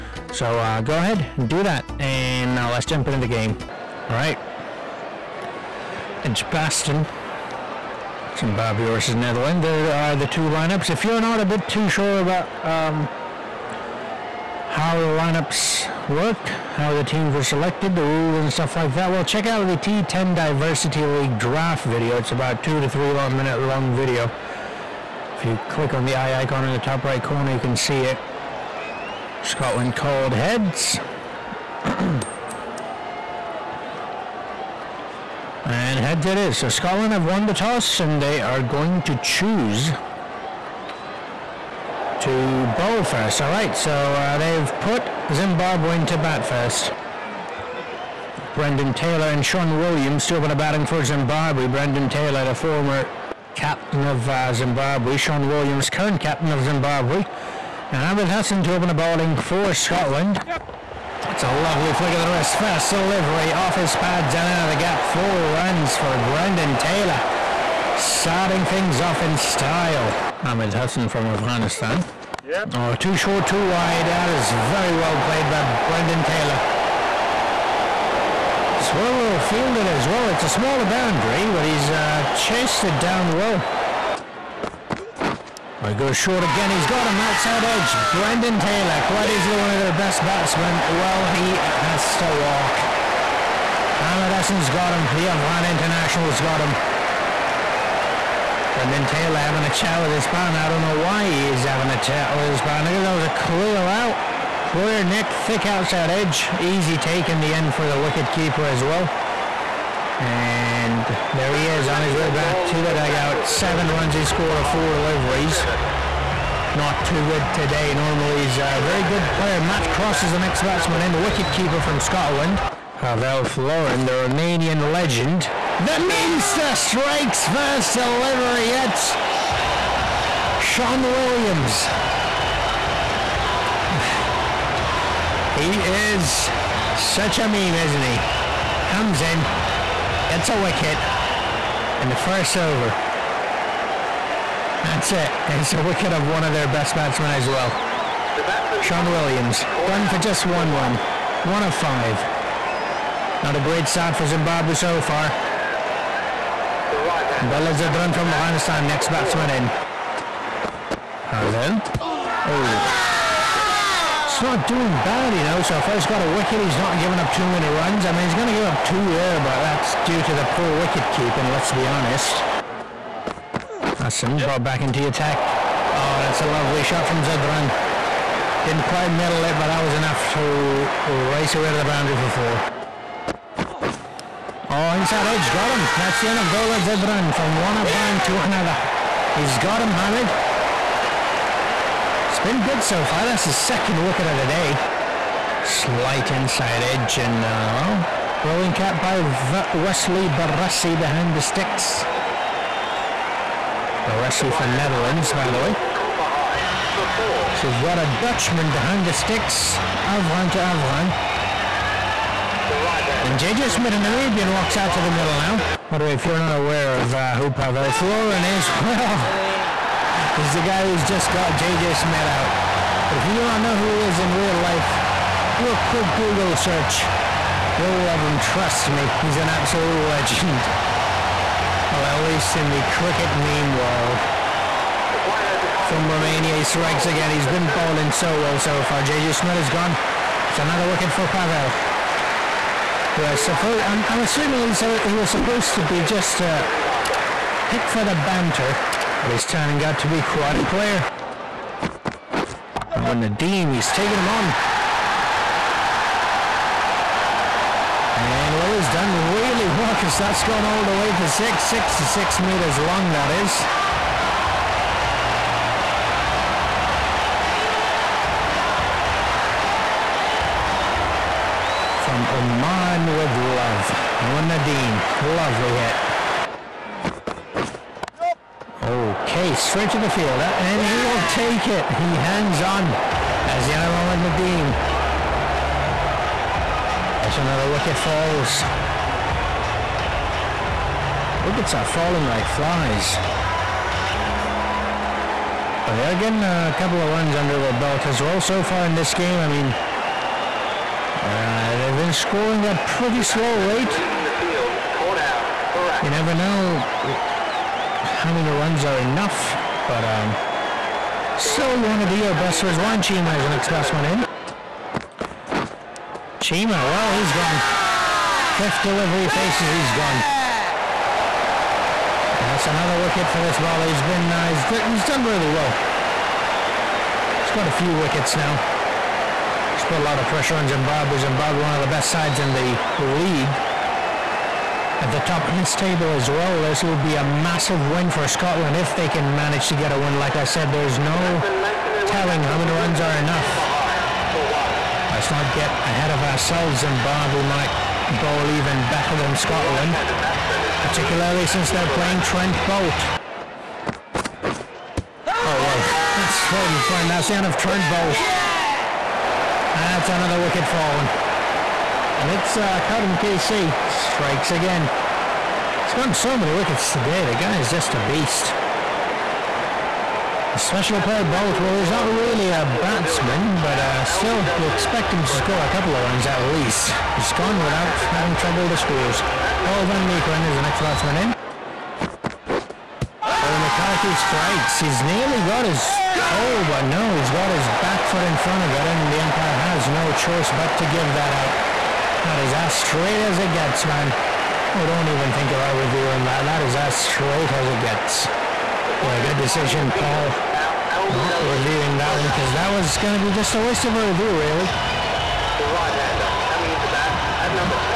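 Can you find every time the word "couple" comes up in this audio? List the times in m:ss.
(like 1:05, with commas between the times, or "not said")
4:56, 6:15.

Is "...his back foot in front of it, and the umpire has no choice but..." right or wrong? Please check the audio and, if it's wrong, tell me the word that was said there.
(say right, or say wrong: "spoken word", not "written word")
right.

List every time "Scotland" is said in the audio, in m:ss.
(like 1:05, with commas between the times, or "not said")
0:29, 0:36, 0:59, 2:02, 5:38, 5:49.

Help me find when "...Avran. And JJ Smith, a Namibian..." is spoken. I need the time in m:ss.
3:30.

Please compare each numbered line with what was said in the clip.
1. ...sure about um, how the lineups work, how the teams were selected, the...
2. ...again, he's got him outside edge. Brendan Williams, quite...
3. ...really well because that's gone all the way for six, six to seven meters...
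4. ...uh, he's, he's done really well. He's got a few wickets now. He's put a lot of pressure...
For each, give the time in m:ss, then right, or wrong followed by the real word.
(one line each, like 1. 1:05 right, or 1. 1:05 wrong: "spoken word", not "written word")
1. 0:11 right
2. 1:26 wrong: "Taylor", not "Williams"
3. 4:19 wrong: "six", not "seven"
4. 5:24 right.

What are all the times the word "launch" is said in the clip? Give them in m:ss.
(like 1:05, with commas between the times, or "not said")
not said.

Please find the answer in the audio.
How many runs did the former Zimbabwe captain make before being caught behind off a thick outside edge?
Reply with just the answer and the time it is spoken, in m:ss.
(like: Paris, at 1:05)
7, at 1:53.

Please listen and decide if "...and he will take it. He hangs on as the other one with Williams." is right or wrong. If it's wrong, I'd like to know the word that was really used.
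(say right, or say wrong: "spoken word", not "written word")
wrong: "Nadim", not "Williams".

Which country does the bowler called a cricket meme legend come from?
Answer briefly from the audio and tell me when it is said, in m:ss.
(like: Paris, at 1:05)
Romania, at 3:55.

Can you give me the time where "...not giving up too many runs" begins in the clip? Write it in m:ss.
2:46.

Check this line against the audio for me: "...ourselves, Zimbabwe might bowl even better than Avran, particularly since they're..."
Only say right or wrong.
wrong.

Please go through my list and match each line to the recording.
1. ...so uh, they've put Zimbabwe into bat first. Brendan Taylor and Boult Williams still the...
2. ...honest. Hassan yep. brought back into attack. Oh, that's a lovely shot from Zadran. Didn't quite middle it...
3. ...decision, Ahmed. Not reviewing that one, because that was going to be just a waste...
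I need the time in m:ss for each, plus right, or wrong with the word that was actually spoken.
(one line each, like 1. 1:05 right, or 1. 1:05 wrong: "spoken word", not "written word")
1. 0:43 wrong: "Sean", not "Boult"
2. 2:51 right
3. 6:39 wrong: "Paul", not "Ahmed".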